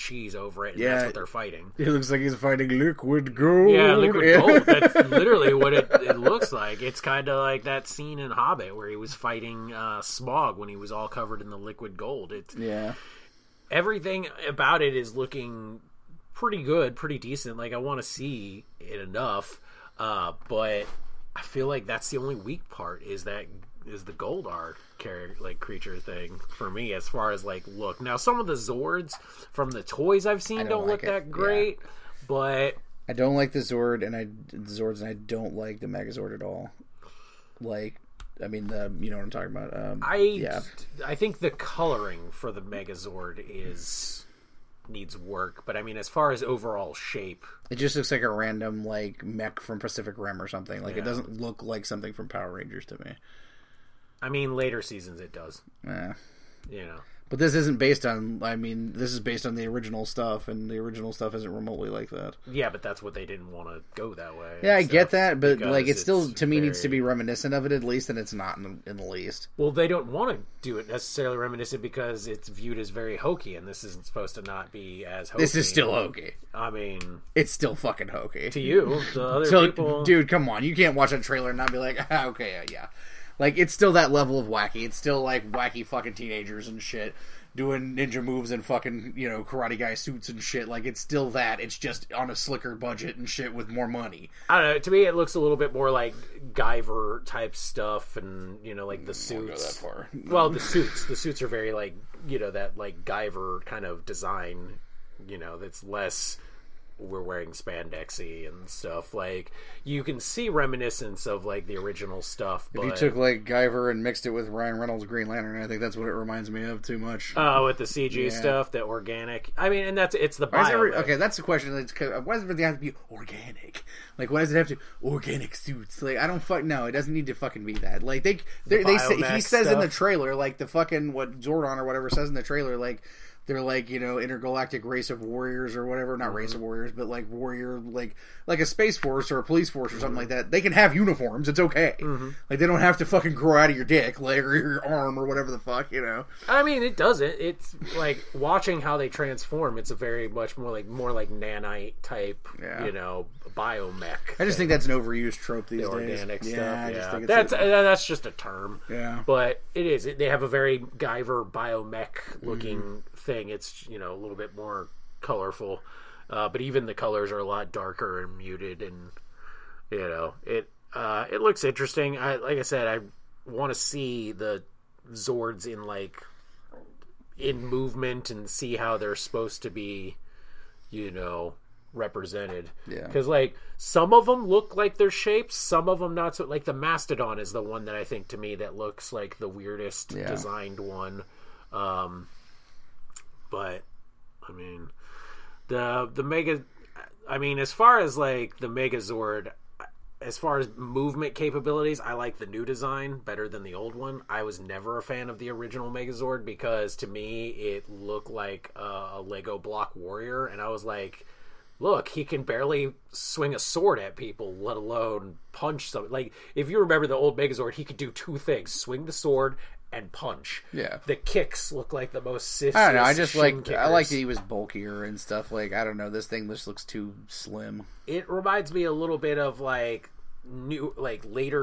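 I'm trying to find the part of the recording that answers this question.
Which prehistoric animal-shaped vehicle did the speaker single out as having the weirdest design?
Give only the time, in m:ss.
3:06.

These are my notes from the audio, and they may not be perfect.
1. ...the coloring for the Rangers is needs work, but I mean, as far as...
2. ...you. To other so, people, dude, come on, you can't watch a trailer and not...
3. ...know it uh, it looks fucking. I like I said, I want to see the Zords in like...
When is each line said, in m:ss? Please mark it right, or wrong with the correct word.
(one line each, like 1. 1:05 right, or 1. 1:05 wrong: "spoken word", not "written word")
1. 0:41 wrong: "Megazord", not "Rangers"
2. 1:18 right
3. 2:50 wrong: "interesting", not "fucking".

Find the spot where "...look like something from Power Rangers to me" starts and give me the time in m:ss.
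0:51.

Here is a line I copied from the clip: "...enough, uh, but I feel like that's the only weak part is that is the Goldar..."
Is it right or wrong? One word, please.
right.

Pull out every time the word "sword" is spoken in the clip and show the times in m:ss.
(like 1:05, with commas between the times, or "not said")
3:33, 3:39.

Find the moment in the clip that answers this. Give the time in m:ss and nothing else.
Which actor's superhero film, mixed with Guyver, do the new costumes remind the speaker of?
1:54.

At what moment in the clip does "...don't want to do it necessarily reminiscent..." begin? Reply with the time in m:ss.
1:09.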